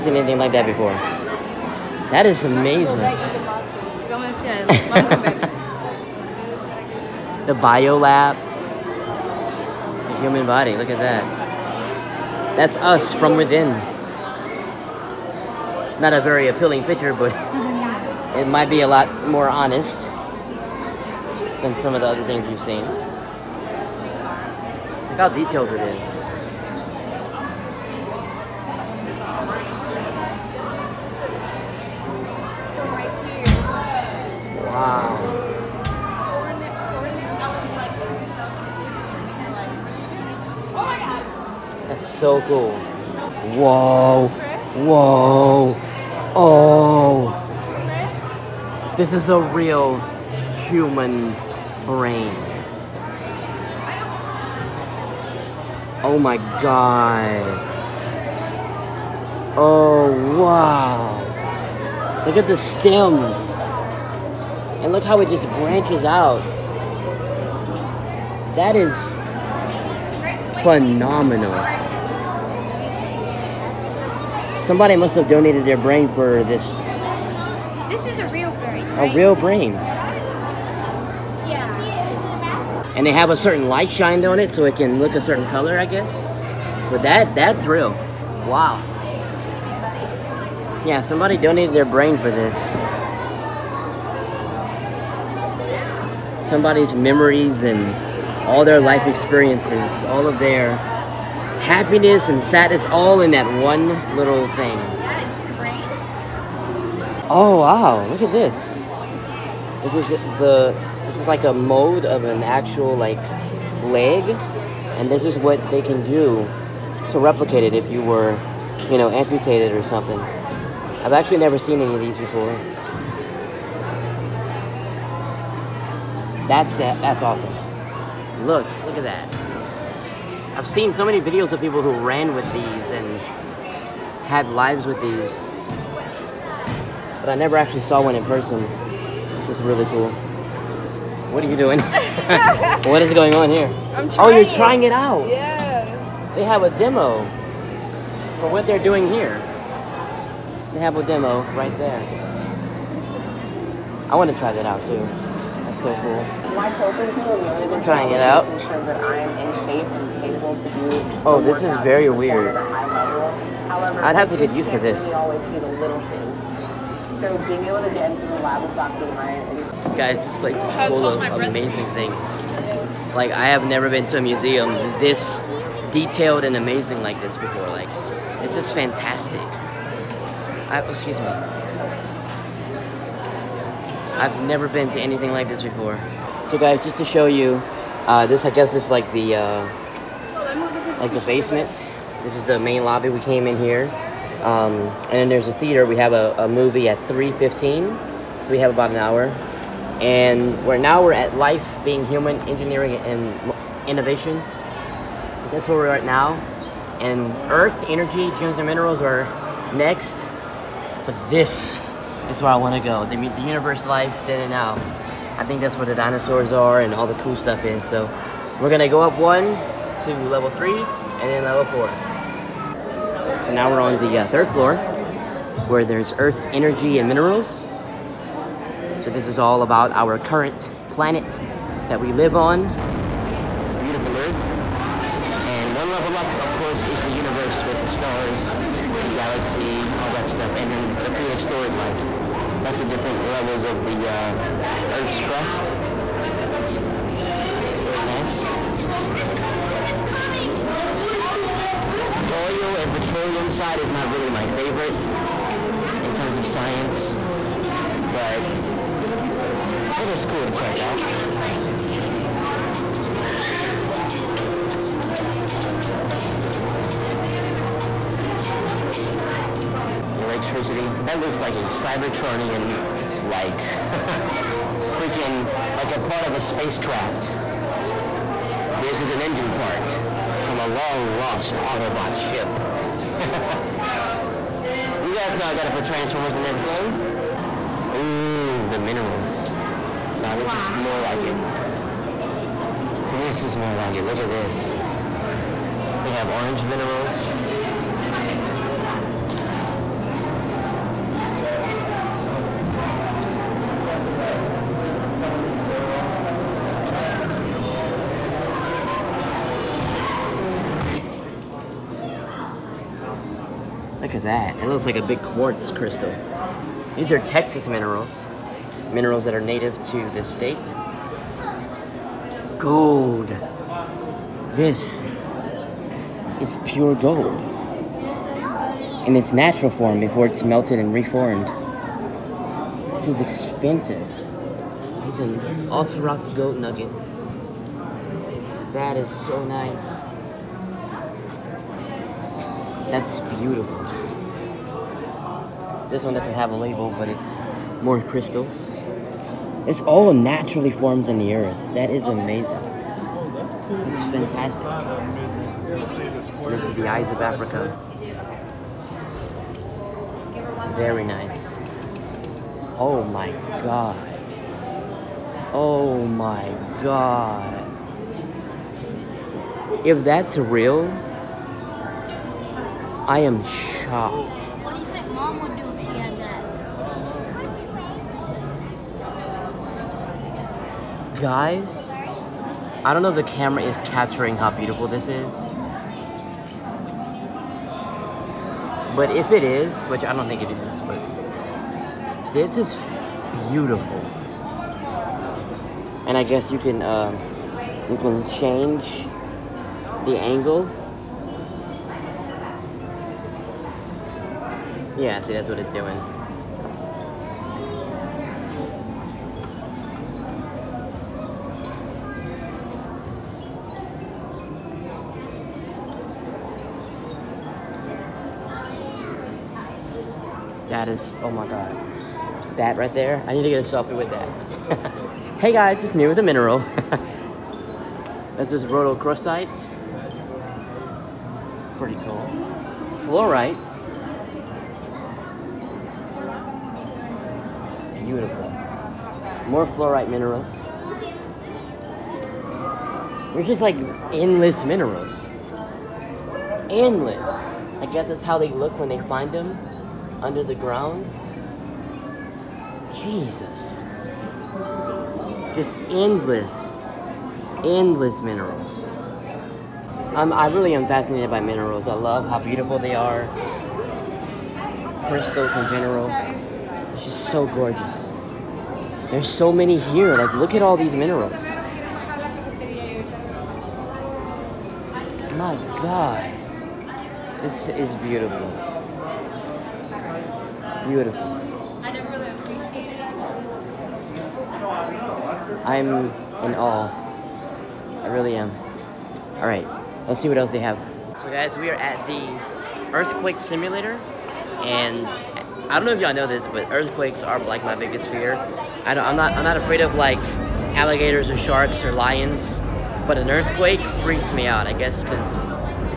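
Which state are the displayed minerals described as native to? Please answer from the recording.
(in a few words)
Texas.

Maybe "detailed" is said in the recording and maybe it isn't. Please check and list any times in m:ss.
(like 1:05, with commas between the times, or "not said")
0:25, 2:55.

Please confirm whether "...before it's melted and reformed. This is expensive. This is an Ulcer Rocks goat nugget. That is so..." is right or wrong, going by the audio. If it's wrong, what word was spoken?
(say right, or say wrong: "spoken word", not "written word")
right.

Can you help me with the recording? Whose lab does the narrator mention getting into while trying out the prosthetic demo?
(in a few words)
Dr. Ryan.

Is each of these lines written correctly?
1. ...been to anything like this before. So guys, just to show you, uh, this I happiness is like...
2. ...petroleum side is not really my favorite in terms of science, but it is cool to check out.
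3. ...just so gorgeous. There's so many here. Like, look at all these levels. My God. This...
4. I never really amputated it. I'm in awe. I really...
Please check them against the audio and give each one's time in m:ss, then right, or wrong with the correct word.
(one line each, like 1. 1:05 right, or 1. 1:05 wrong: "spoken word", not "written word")
1. 3:04 wrong: "guess", not "happiness"
2. 4:12 right
3. 7:47 wrong: "minerals", not "levels"
4. 8:01 wrong: "appreciated", not "amputated".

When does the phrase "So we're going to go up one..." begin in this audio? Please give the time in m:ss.
3:37.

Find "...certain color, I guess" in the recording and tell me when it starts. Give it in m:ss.
1:25.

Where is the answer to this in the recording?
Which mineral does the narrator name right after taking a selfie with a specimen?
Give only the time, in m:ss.
7:08.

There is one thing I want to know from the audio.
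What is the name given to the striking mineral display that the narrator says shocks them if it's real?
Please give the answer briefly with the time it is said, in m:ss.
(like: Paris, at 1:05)
the eyes of Africa, at 5:56.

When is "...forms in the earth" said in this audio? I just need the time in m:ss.
5:50.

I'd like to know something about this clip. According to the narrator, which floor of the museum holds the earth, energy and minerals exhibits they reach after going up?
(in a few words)
third floor.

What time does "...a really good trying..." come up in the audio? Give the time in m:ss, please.
2:37.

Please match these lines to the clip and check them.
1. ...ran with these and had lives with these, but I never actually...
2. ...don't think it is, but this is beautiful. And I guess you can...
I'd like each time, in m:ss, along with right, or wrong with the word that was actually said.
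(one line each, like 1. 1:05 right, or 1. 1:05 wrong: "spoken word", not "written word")
1. 2:12 right
2. 6:30 right.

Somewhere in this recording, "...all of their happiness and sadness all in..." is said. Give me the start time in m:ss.
1:40.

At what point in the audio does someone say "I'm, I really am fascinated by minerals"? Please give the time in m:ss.
7:40.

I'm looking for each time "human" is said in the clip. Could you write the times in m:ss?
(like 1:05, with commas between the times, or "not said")
0:10, 0:50, 3:22.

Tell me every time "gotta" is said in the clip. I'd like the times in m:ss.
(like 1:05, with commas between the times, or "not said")
4:45.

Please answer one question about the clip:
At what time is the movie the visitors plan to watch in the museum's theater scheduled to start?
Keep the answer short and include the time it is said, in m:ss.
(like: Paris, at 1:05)
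3:15, at 3:17.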